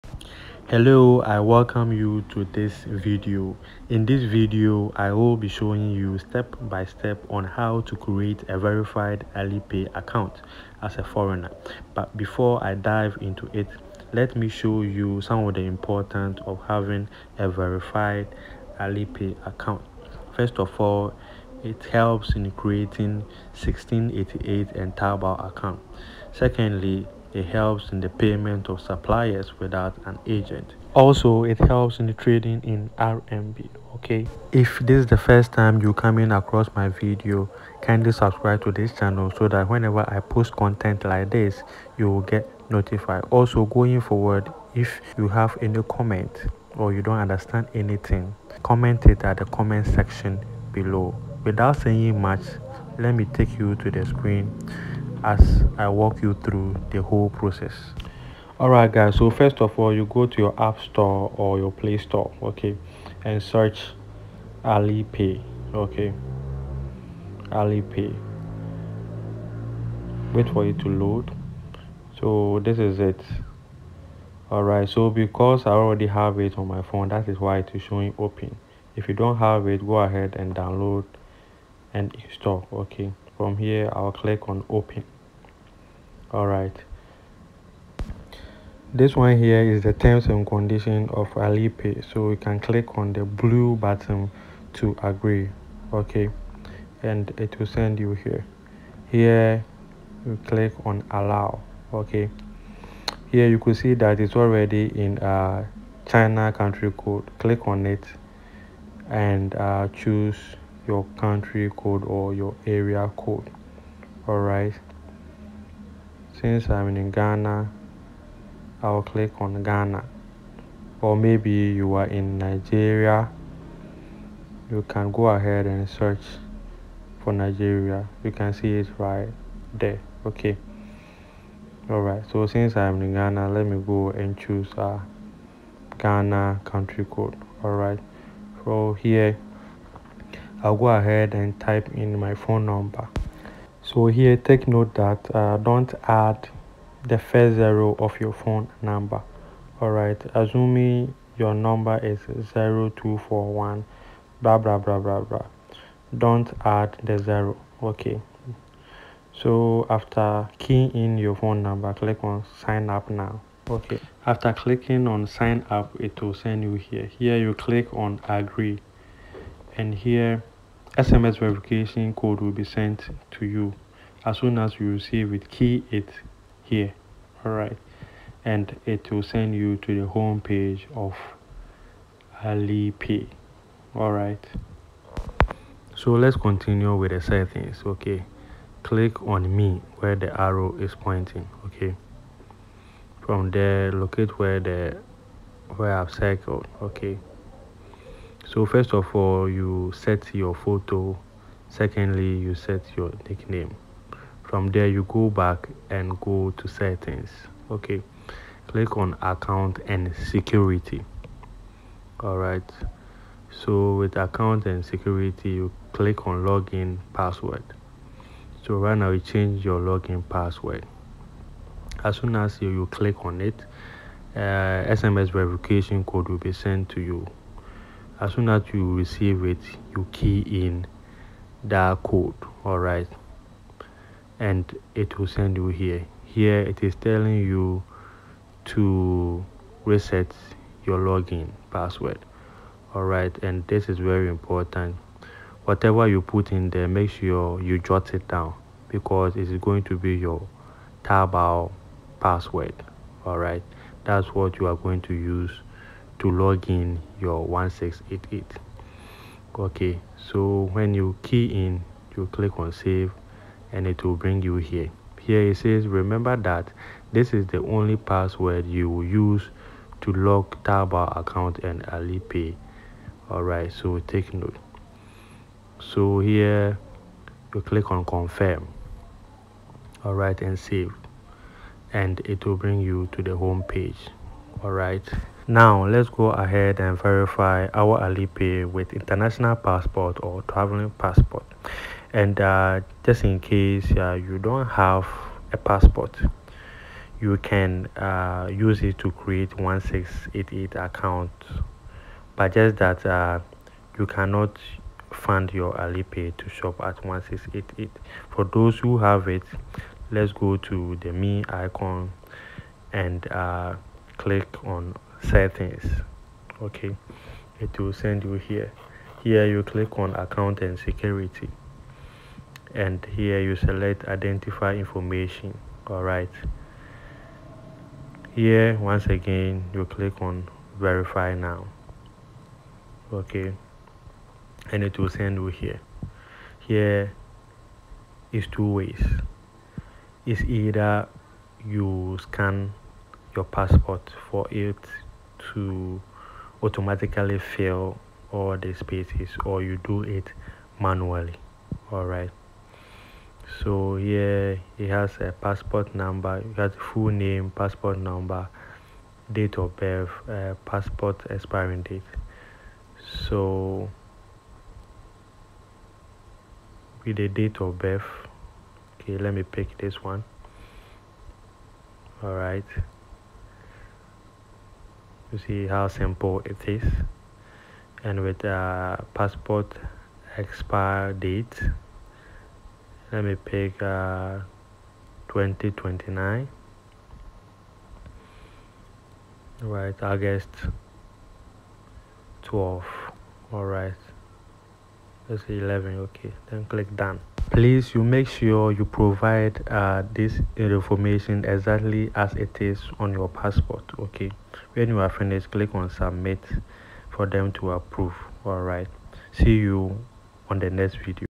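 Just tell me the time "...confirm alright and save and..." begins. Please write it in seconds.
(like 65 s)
278 s.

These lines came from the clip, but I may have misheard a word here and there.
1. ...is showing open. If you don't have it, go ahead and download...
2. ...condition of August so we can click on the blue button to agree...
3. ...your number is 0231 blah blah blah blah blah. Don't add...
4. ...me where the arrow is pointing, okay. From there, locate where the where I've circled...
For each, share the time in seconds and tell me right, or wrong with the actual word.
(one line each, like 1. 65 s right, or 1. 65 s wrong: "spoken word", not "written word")
1. 77 s right
2. 90 s wrong: "Alipay", not "August"
3. 151 s wrong: "0241", not "0231"
4. 189 s right.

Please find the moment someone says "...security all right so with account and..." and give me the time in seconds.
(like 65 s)
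210 s.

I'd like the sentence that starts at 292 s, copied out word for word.
And uh, just in case uh, you don't have a passport, you can uh, use it to create 1688 account.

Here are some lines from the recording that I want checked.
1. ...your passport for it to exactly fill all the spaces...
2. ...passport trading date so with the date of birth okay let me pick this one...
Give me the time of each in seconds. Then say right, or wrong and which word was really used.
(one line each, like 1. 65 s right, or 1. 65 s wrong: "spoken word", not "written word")
1. 343 s wrong: "automatically", not "exactly"
2. 360 s wrong: "expiring", not "trading".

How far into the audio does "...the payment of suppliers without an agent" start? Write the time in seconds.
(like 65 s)
28 s.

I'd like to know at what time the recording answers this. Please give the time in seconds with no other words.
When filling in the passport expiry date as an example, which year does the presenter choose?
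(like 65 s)
385 s.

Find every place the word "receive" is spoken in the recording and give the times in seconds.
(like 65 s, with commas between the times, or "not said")
174 s, 228 s.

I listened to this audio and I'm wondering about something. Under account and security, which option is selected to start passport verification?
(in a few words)
identify information.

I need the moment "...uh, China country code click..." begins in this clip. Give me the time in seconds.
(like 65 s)
105 s.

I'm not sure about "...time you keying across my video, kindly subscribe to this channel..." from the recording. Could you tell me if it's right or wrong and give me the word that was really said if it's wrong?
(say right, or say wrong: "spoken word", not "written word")
wrong: "coming", not "keying".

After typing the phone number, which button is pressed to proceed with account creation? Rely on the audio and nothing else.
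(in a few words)
sign up now.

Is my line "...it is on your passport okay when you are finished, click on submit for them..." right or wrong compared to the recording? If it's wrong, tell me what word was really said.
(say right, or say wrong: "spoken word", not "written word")
right.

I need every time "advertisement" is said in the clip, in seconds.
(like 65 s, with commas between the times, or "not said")
not said.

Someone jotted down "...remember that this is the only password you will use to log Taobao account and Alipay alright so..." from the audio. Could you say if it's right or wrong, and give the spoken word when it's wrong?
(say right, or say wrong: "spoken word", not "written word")
right.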